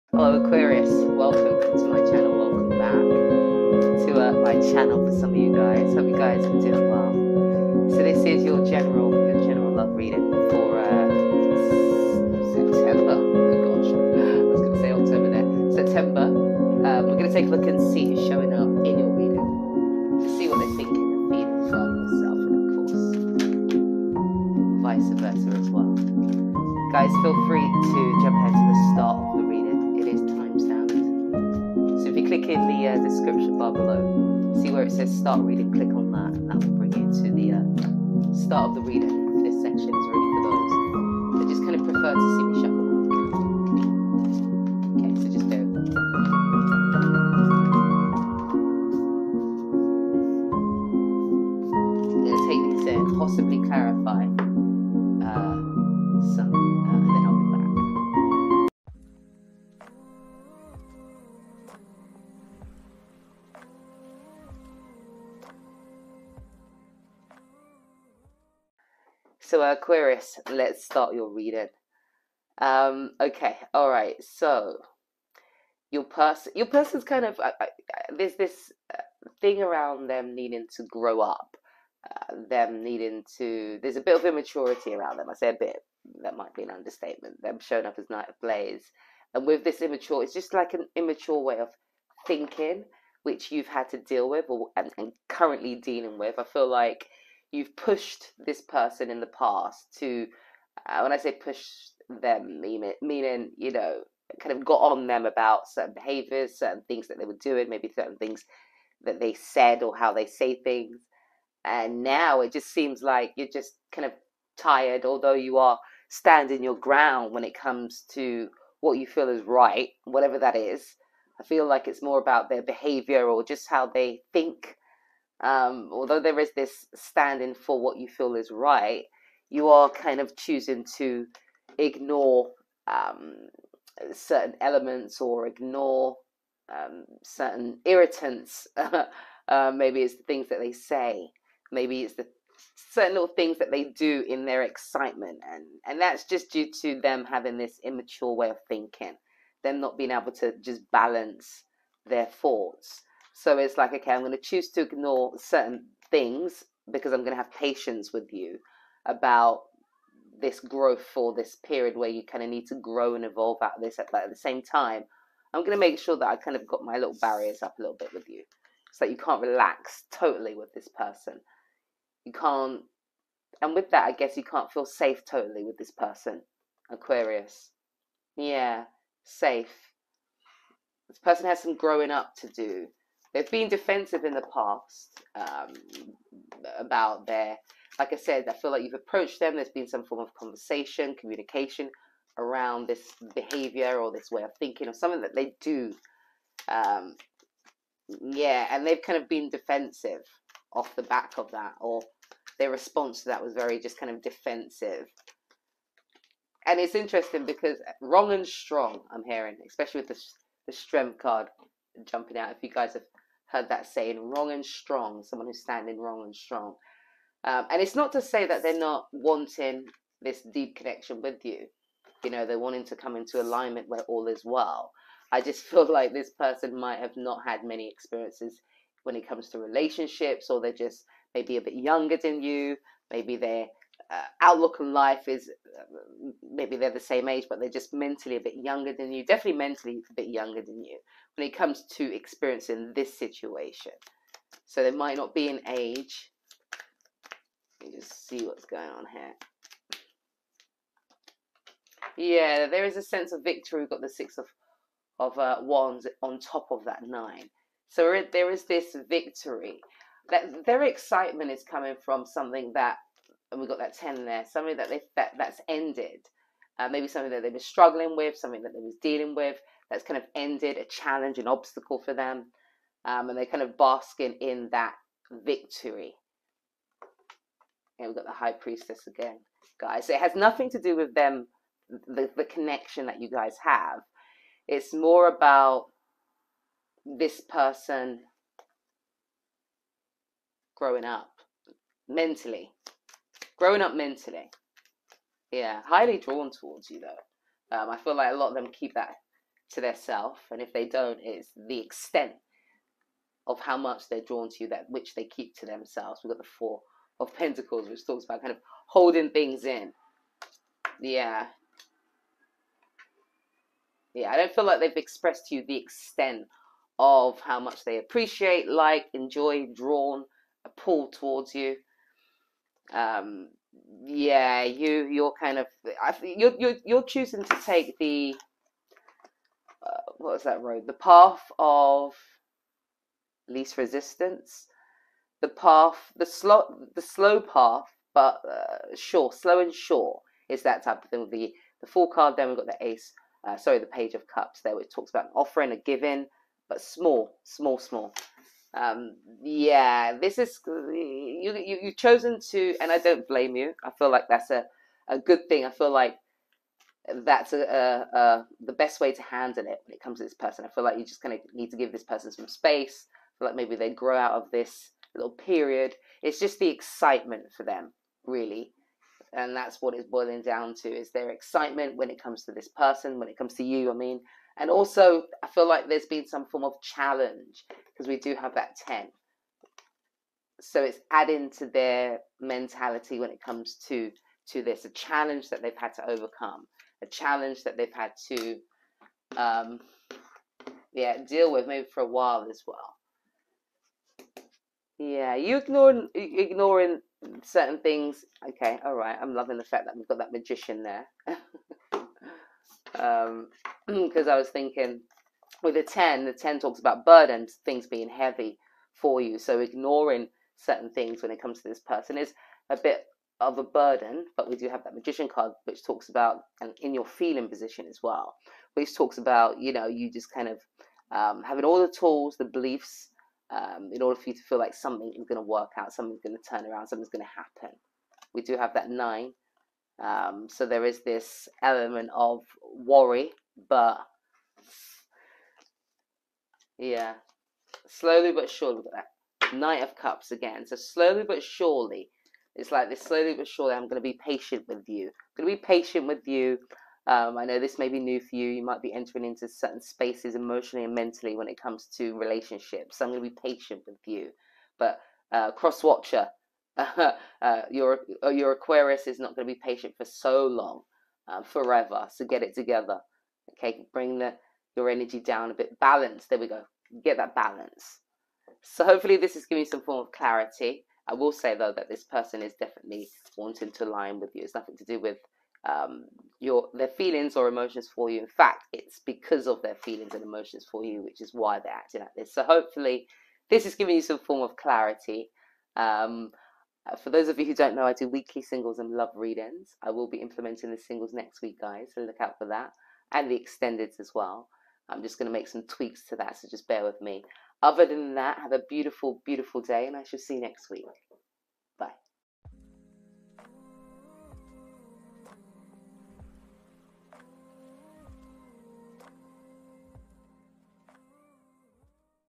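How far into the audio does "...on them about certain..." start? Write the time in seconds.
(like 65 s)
104 s.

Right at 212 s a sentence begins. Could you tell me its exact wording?
If you guys have heard that saying wrong and strong, someone who's standing wrong and strong.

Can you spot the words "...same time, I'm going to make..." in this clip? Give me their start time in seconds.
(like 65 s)
164 s.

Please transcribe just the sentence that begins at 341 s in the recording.
The the full card, then we've got the ace.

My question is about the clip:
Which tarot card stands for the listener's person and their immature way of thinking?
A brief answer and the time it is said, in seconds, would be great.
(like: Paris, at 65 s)
Knight of Blades, at 88 s.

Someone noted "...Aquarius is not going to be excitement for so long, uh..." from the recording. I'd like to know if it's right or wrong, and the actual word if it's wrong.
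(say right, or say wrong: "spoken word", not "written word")
wrong: "patient", not "excitement".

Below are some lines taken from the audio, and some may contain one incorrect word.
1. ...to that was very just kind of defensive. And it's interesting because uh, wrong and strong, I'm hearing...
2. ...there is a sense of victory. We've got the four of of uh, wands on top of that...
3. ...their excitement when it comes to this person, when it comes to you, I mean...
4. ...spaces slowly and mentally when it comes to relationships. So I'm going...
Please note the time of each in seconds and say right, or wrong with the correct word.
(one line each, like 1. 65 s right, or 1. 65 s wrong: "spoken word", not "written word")
1. 203 s right
2. 252 s wrong: "six", not "four"
3. 371 s right
4. 449 s wrong: "emotionally", not "slowly".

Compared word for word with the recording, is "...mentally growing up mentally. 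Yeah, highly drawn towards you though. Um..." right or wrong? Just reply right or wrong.
right.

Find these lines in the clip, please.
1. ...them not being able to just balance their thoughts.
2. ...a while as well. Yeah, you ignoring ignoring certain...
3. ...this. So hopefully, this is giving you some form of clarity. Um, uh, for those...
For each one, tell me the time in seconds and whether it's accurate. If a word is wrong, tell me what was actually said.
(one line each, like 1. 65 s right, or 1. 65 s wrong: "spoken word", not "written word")
1. 149 s right
2. 392 s right
3. 482 s right.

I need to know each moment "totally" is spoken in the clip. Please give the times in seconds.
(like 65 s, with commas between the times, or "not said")
170 s, 175 s.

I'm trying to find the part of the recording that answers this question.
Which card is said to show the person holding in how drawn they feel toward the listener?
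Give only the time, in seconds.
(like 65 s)
306 s.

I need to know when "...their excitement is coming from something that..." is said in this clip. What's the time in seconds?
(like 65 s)
260 s.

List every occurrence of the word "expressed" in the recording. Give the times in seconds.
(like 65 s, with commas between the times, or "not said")
314 s.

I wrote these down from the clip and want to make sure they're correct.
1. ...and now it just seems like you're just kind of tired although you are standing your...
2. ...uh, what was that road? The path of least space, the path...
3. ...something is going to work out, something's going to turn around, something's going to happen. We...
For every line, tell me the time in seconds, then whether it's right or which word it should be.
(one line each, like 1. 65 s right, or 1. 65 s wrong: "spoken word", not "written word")
1. 111 s right
2. 329 s wrong: "resistance", not "space"
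3. 424 s right.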